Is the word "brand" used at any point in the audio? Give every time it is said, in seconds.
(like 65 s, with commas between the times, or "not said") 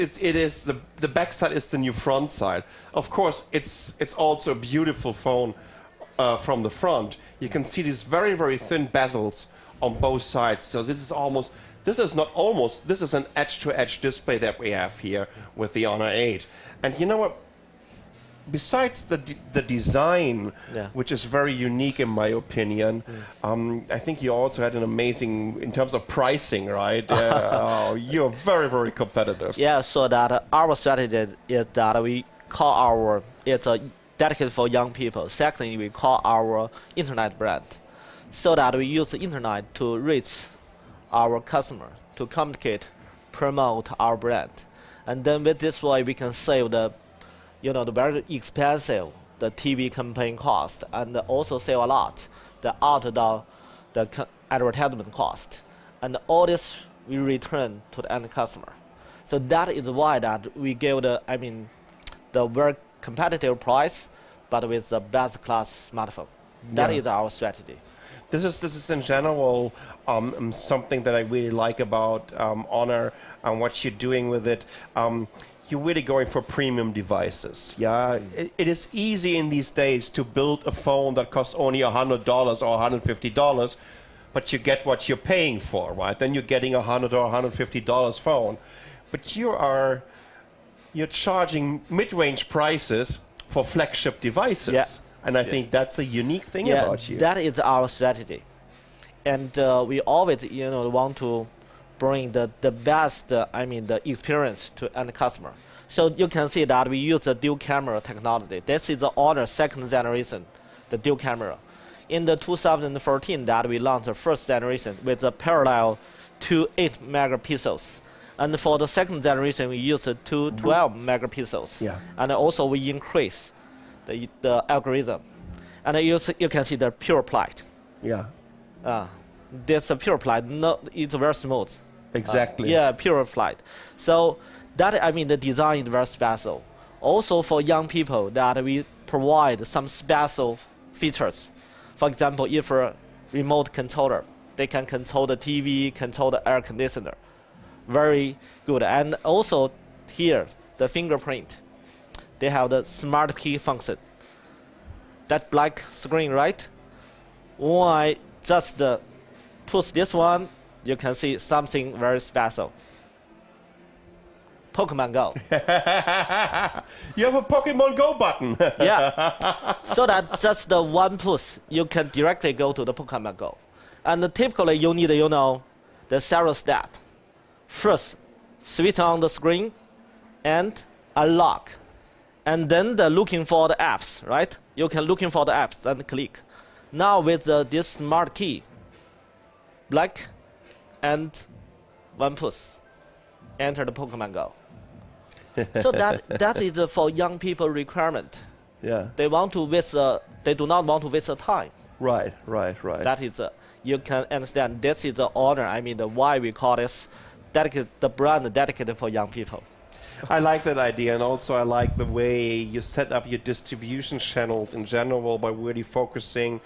37 s, 44 s, 208 s.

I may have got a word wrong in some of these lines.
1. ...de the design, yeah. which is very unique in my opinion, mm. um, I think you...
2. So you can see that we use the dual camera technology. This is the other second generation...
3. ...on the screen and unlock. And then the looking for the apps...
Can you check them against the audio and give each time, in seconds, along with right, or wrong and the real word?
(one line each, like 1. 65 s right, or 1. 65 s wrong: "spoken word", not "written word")
1. 19 s right
2. 105 s right
3. 178 s right.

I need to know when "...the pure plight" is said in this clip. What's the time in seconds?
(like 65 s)
126 s.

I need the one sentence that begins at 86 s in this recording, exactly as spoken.
Then you're getting a $100 or $150 phone.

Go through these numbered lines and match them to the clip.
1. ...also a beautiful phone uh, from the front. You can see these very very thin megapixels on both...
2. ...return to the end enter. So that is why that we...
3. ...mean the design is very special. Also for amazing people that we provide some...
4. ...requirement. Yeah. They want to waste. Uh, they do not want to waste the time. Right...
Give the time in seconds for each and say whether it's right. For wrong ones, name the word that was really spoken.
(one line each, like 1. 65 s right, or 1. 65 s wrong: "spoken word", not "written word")
1. 4 s wrong: "bezels", not "megapixels"
2. 57 s wrong: "customer", not "enter"
3. 135 s wrong: "young", not "amazing"
4. 197 s right.